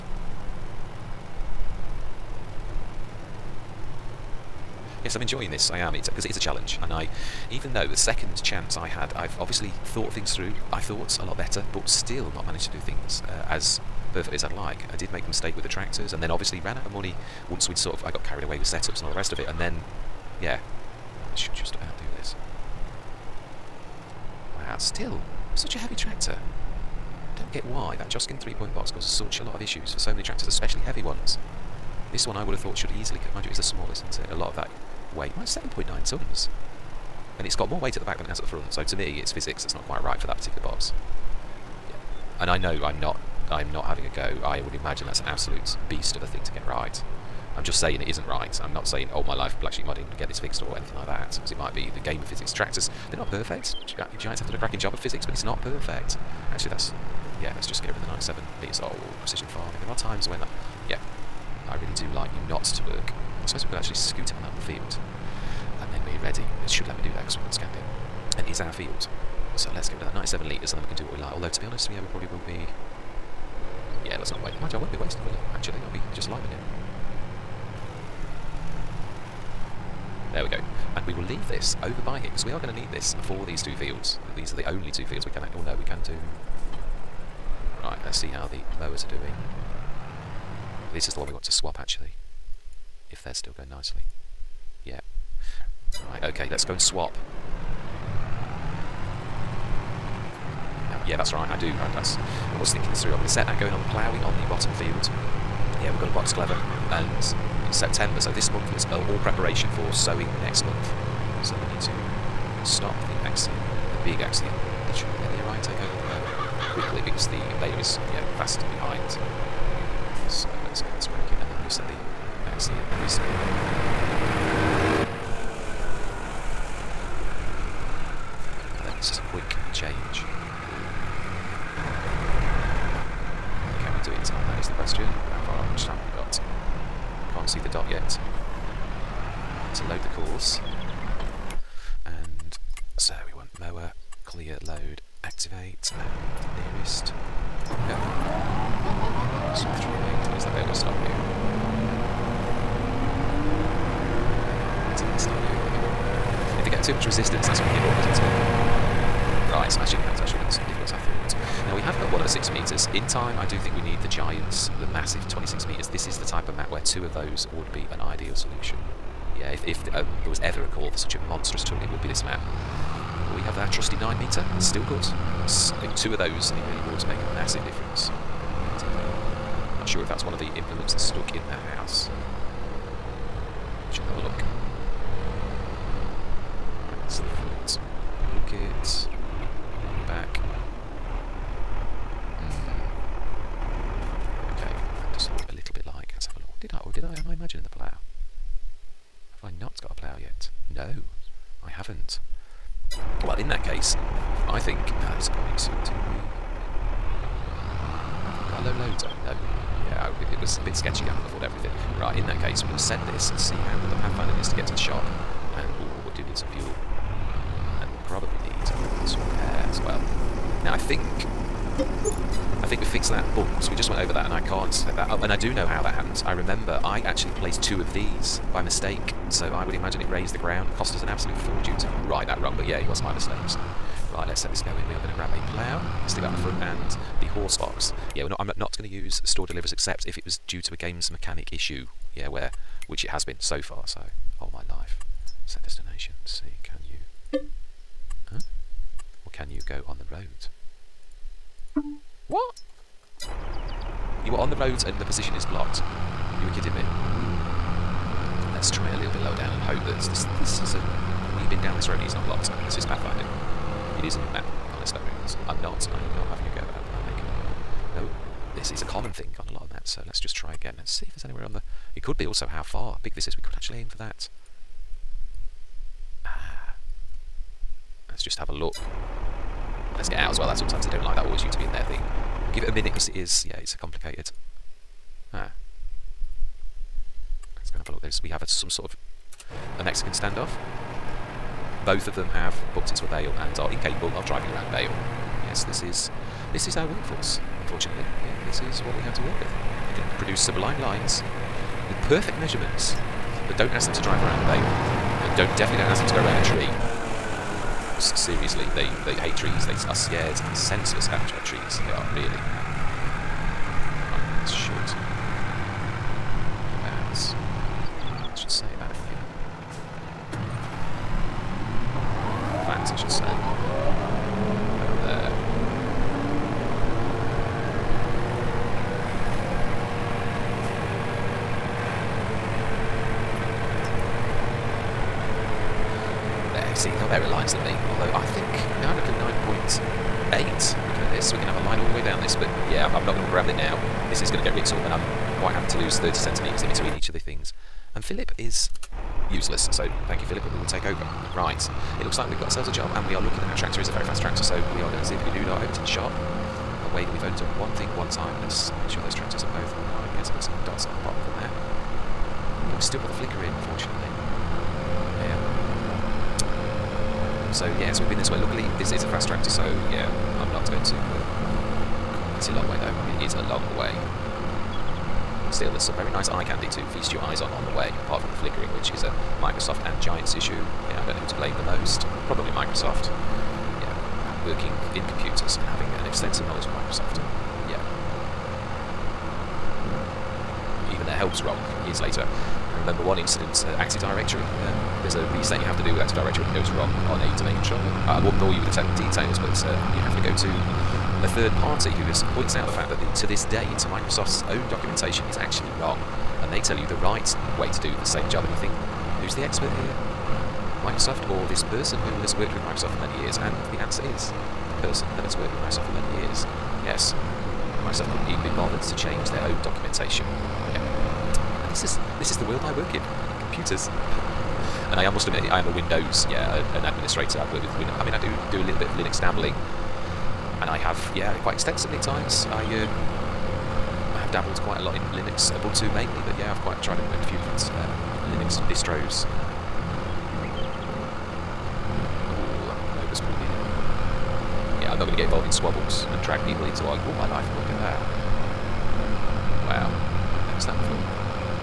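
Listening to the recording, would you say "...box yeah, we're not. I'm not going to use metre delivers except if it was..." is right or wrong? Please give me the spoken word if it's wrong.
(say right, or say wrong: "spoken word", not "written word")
wrong: "store", not "metre".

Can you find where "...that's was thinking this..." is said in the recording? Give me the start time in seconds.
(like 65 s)
101 s.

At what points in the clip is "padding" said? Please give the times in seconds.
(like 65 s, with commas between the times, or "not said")
not said.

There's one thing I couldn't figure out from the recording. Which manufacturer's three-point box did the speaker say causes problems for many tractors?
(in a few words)
Joskin.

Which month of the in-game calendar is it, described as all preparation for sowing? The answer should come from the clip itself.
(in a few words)
September.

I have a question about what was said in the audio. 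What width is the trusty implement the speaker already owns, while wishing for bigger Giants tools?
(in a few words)
9 metre.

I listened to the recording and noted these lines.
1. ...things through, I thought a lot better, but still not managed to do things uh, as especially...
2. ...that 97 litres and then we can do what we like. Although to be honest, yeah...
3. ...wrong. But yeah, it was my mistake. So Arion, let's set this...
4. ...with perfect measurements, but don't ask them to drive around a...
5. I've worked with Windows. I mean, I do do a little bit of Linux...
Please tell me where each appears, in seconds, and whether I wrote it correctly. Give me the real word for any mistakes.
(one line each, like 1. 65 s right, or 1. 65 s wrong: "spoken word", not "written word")
1. 10 s wrong: "perfectly", not "especially"
2. 70 s right
3. 232 s wrong: "Right", not "Arion"
4. 301 s right
5. 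427 s right.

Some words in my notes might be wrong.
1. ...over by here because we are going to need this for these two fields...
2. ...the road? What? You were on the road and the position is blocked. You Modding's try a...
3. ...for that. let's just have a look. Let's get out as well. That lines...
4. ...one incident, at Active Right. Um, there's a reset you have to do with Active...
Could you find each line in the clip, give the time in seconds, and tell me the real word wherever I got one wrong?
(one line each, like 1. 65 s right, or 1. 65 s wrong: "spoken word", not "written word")
1. 81 s right
2. 249 s wrong: "Let", not "Modding"
3. 273 s wrong: "sometimes", not "lines"
4. 393 s wrong: "Directory", not "Right".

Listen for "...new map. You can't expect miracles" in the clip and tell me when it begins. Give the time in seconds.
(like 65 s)
264 s.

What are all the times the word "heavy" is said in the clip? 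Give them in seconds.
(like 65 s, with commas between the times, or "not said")
25 s, 30 s.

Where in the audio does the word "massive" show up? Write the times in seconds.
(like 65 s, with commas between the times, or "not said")
164 s, 177 s.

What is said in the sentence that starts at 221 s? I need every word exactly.
I think we fixed that bug because we just went over that and I can't set that up.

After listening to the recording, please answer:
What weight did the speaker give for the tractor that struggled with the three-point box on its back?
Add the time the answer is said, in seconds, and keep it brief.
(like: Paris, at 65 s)
7.9 tons, at 35 s.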